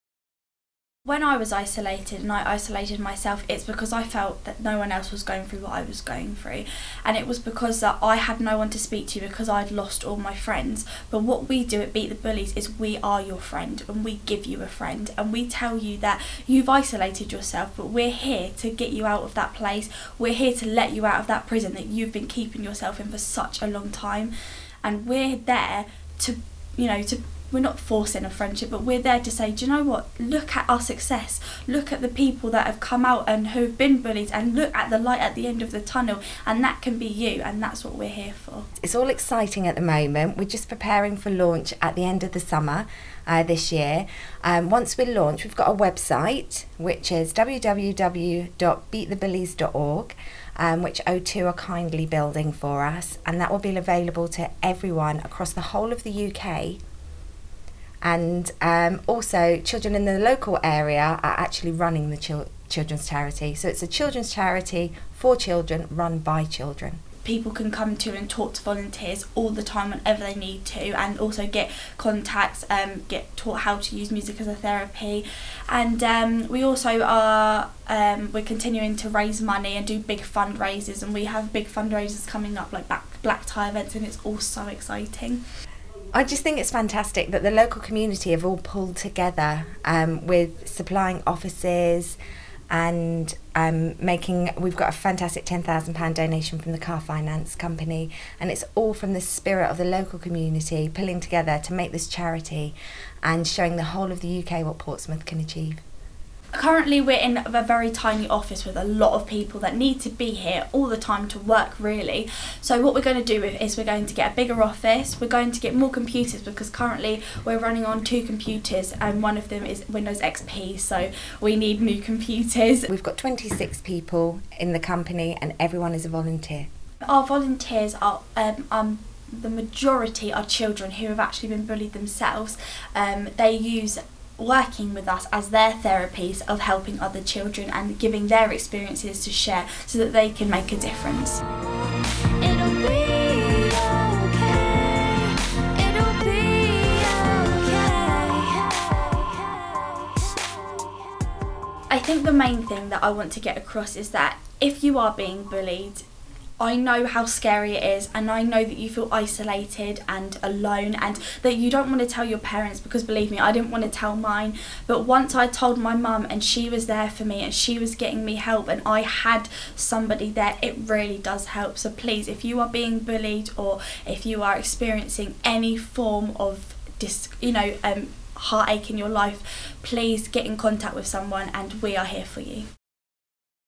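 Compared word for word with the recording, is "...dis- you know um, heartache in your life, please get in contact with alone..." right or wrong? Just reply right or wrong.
wrong.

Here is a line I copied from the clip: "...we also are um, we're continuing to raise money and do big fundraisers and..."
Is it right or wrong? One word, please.
right.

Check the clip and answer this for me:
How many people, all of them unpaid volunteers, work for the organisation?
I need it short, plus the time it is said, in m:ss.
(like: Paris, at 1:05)
26, at 2:03.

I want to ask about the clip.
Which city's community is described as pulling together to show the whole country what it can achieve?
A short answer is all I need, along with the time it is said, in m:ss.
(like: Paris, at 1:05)
Portsmouth, at 1:44.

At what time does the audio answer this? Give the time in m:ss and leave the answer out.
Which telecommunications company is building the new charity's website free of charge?
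0:51.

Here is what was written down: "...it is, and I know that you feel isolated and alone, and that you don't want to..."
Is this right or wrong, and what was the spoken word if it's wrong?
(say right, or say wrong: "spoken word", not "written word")
right.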